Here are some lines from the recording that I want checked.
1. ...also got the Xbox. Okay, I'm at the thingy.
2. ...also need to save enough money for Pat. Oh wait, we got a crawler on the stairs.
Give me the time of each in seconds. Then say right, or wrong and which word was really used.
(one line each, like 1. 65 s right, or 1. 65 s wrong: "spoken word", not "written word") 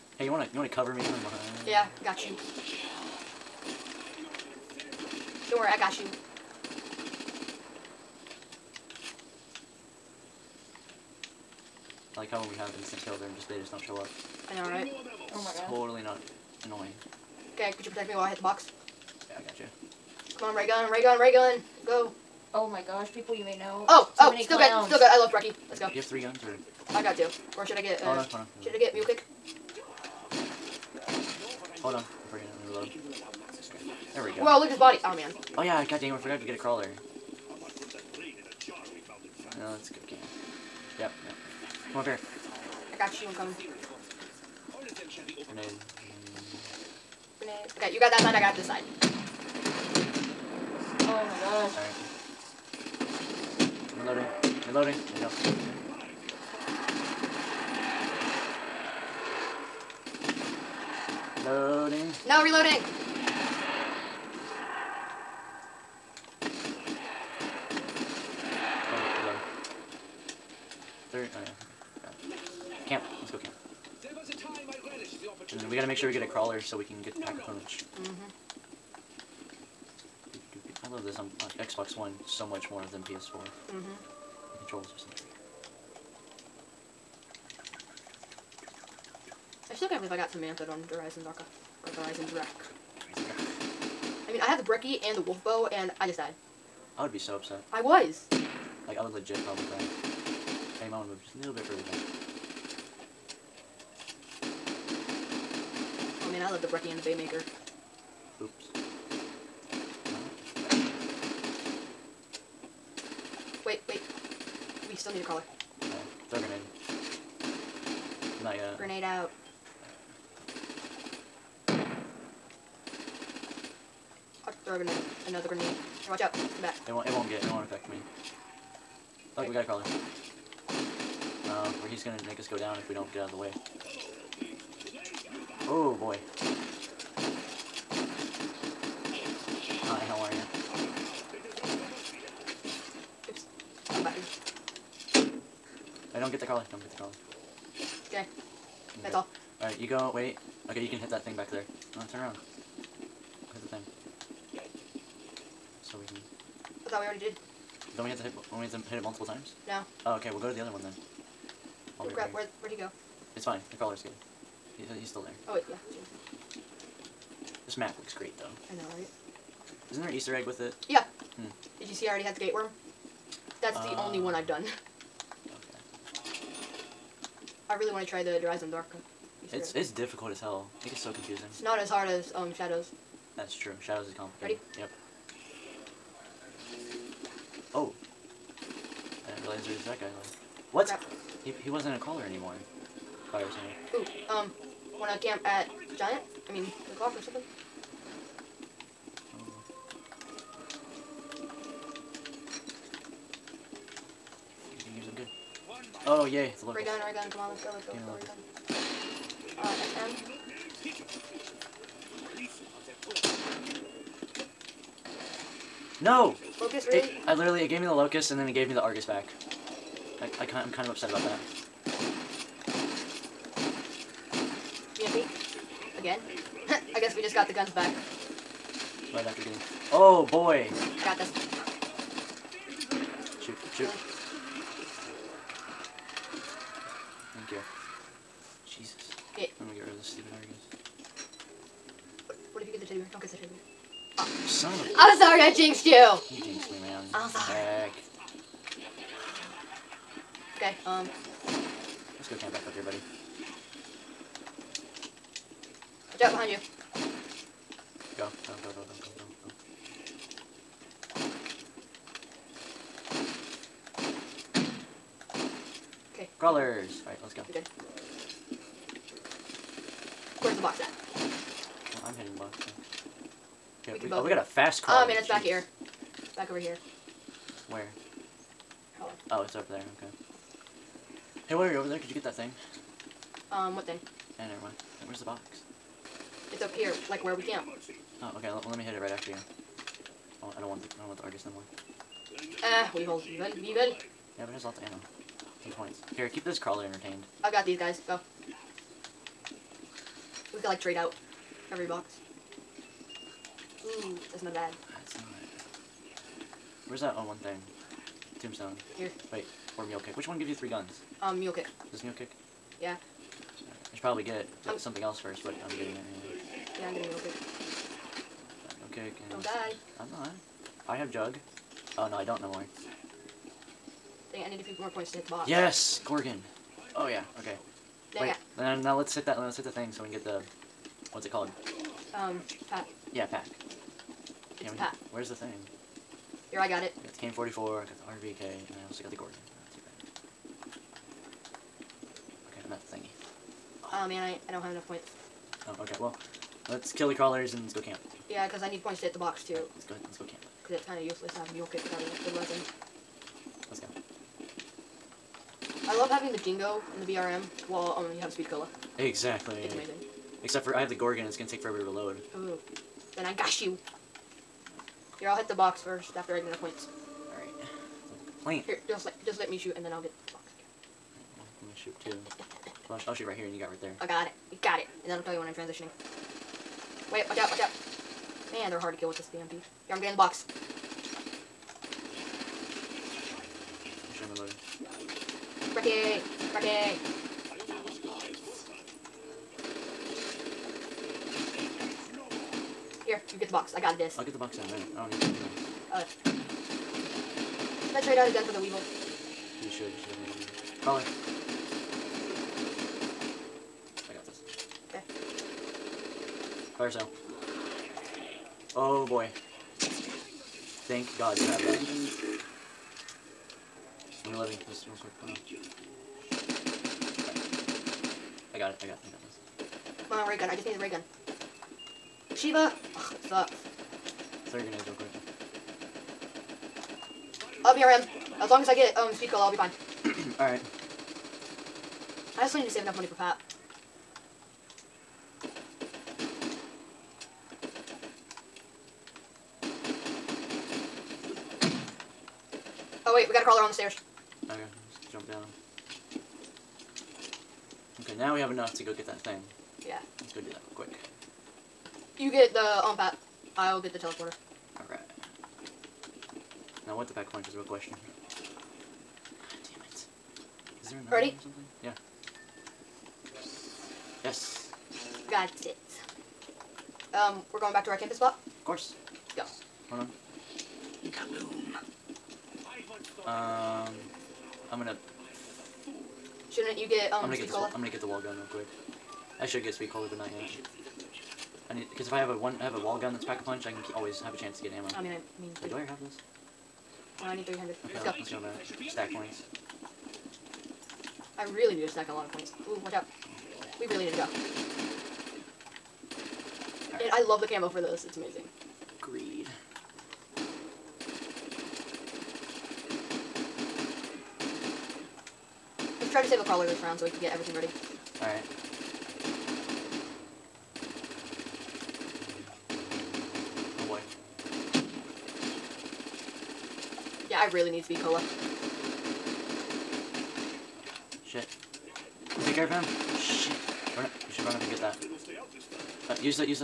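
1. 338 s wrong: "Gorgon", not "Xbox"
2. 432 s right.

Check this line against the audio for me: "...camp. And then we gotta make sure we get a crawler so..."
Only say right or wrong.
right.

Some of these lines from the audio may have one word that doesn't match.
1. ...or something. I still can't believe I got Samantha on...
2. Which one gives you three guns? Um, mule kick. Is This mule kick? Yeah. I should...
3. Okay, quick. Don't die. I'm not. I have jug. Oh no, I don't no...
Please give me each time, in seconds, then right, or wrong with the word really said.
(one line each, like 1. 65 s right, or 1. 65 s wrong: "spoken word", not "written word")
1. 84 s right
2. 310 s right
3. 318 s right.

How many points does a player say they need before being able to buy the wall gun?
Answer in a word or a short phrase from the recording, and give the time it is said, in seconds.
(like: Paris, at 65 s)
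300, at 487 s.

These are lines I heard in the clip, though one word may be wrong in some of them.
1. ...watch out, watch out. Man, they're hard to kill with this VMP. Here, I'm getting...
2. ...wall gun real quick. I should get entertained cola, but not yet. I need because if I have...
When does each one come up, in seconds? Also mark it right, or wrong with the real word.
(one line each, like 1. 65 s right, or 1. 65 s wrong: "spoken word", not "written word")
1. 377 s right
2. 478 s wrong: "speed", not "entertained".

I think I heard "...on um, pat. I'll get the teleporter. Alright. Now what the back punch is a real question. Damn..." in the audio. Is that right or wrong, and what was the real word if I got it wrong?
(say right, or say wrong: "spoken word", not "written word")
right.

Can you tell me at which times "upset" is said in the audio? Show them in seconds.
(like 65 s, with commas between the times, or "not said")
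97 s, 220 s.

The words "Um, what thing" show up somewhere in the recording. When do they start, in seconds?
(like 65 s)
283 s.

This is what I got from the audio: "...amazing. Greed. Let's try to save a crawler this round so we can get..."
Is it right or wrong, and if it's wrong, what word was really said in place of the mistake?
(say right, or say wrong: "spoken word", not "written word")
right.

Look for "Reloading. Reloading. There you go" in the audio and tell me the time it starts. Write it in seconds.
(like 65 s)
54 s.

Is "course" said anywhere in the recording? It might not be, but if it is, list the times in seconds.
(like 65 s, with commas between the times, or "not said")
468 s.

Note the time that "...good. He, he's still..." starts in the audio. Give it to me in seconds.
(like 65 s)
164 s.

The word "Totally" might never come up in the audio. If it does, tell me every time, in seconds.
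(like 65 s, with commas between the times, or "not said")
15 s.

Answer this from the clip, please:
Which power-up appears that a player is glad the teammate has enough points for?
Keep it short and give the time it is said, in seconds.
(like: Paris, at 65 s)
Fire sale, at 406 s.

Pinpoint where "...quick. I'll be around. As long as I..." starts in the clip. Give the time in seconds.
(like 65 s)
424 s.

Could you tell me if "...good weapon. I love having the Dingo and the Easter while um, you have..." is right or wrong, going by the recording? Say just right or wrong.
wrong.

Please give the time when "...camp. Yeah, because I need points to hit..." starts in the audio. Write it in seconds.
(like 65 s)
347 s.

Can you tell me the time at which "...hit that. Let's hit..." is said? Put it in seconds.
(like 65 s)
329 s.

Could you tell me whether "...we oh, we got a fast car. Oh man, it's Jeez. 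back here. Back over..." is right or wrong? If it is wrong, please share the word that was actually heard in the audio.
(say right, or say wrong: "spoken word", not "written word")
right.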